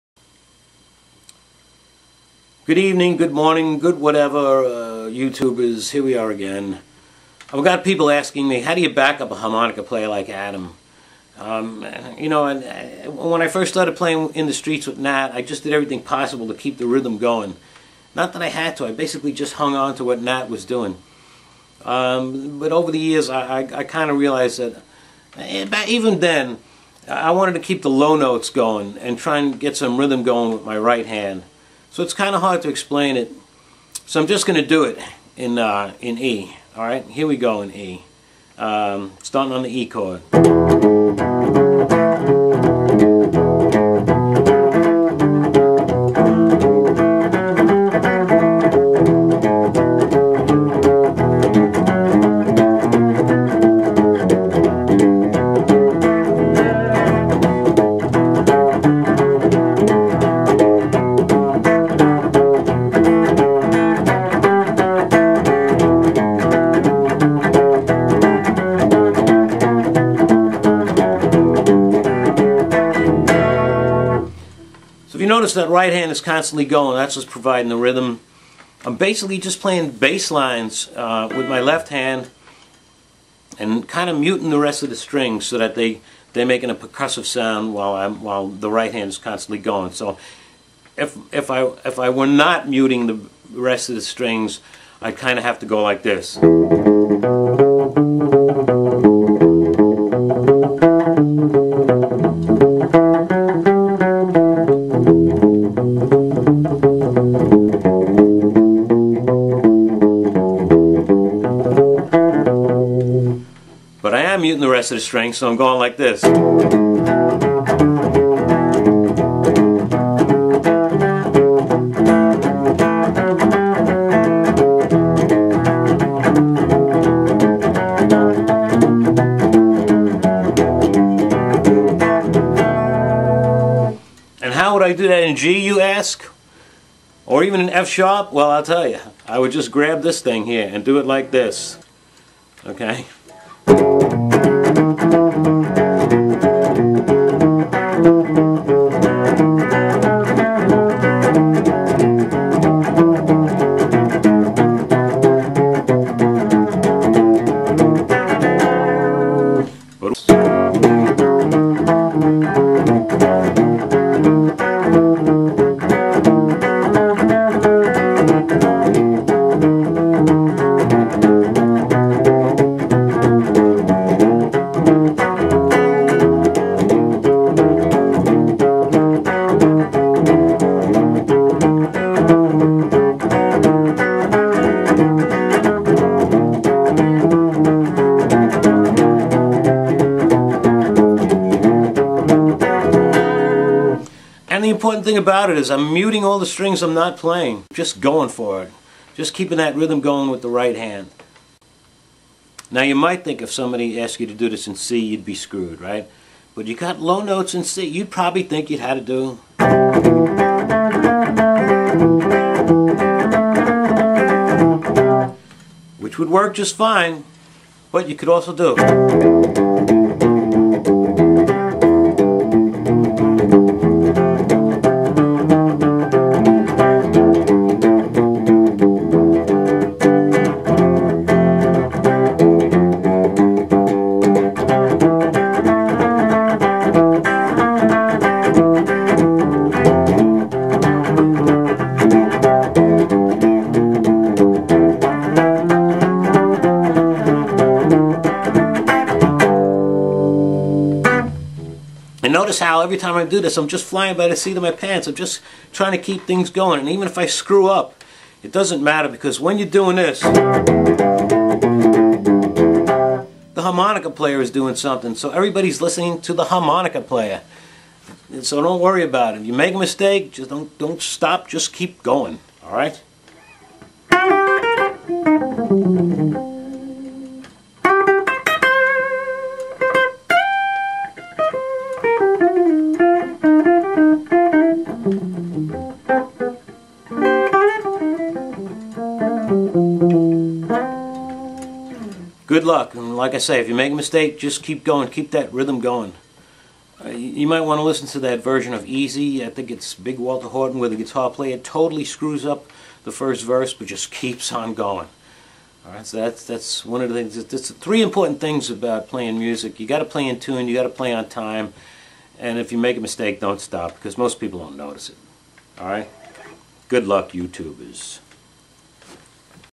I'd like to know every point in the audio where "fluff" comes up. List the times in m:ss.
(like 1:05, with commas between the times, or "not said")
not said.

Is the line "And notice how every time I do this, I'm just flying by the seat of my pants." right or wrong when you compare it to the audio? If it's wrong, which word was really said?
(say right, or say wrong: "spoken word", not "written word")
right.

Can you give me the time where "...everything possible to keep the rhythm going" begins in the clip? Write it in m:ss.
0:15.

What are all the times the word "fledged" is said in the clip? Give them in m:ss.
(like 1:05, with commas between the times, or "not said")
not said.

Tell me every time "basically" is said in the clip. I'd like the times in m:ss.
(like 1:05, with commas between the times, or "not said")
0:18, 1:18.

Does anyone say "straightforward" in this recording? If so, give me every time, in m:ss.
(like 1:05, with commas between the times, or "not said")
not said.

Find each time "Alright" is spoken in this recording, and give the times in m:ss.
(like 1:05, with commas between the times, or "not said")
0:36.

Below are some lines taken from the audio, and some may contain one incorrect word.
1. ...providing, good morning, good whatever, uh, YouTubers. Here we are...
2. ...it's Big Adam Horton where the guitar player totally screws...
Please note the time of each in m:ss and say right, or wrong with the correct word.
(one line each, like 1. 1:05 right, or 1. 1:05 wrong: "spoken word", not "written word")
1. 0:02 wrong: "evening", not "providing"
2. 4:59 wrong: "Walter", not "Adam".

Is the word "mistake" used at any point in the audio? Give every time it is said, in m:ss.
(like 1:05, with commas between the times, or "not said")
4:29, 4:53, 5:13.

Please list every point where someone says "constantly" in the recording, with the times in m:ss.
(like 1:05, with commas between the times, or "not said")
1:16, 1:29.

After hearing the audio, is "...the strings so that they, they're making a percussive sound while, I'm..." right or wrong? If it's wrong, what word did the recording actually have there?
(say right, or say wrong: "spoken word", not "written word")
right.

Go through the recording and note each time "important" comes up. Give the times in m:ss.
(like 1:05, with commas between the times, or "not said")
3:14, 5:08.